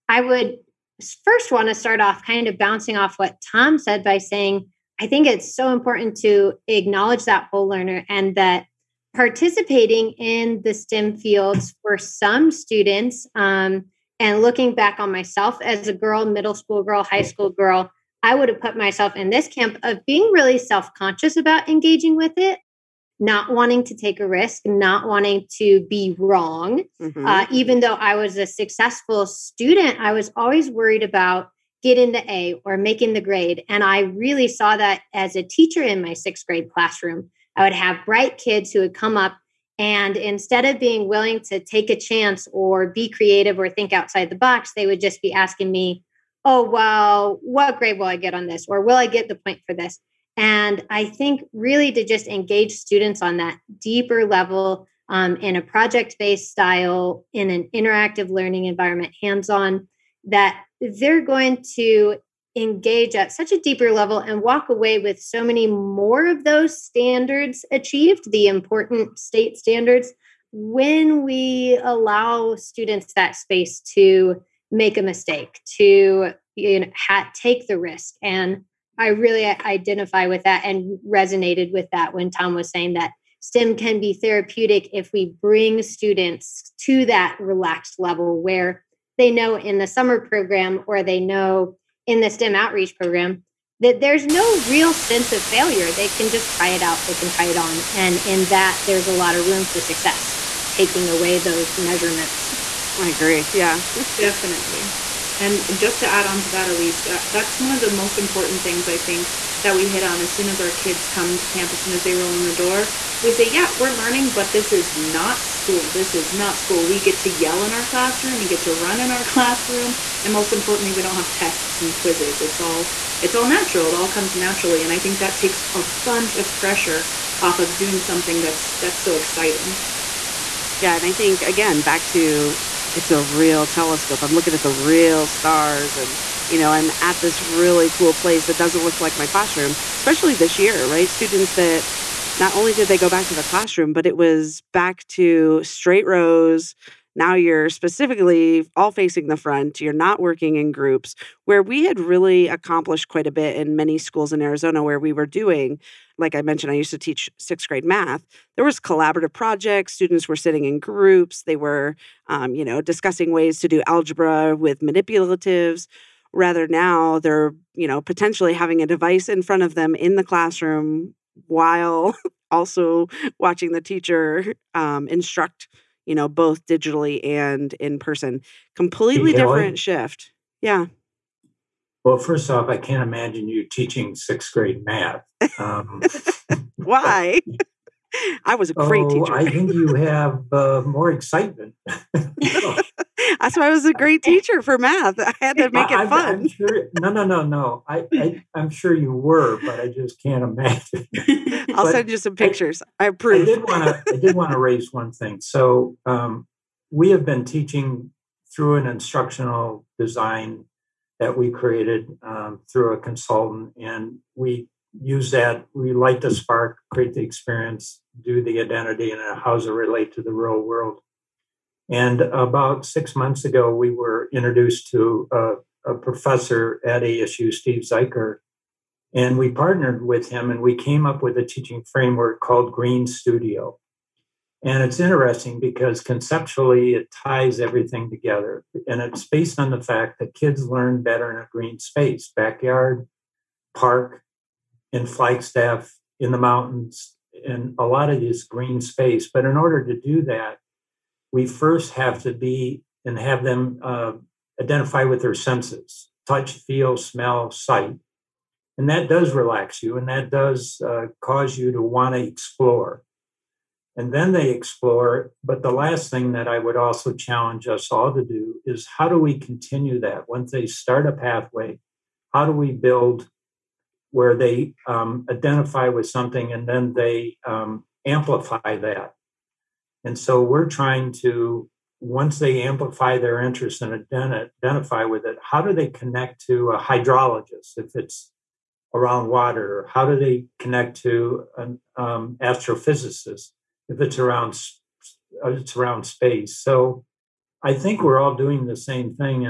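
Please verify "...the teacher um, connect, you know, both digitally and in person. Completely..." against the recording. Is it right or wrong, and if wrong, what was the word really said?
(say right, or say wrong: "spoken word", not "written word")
wrong: "instruct", not "connect".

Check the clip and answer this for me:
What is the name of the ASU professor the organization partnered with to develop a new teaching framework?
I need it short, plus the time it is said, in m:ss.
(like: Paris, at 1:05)
Steve Zeiker, at 3:47.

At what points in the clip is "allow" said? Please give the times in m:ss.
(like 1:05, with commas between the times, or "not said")
1:11.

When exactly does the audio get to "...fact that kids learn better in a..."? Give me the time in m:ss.
3:59.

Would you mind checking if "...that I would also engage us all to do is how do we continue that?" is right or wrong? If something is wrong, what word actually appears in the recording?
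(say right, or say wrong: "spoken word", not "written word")
wrong: "challenge", not "engage".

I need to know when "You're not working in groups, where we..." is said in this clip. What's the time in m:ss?
2:29.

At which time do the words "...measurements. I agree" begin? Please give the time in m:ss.
1:41.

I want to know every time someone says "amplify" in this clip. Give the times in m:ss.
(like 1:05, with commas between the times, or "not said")
4:38, 4:42.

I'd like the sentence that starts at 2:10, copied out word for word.
Yeah, and I think again back to it's a real telescope.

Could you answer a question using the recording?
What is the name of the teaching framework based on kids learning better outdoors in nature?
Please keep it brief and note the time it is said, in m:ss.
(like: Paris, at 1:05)
Green Studio, at 3:52.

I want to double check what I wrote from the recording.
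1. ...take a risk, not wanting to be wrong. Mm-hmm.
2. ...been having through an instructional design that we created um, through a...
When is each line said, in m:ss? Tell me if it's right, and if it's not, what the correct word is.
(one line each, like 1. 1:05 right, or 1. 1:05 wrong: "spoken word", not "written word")
1. 0:23 right
2. 3:27 wrong: "teaching", not "having".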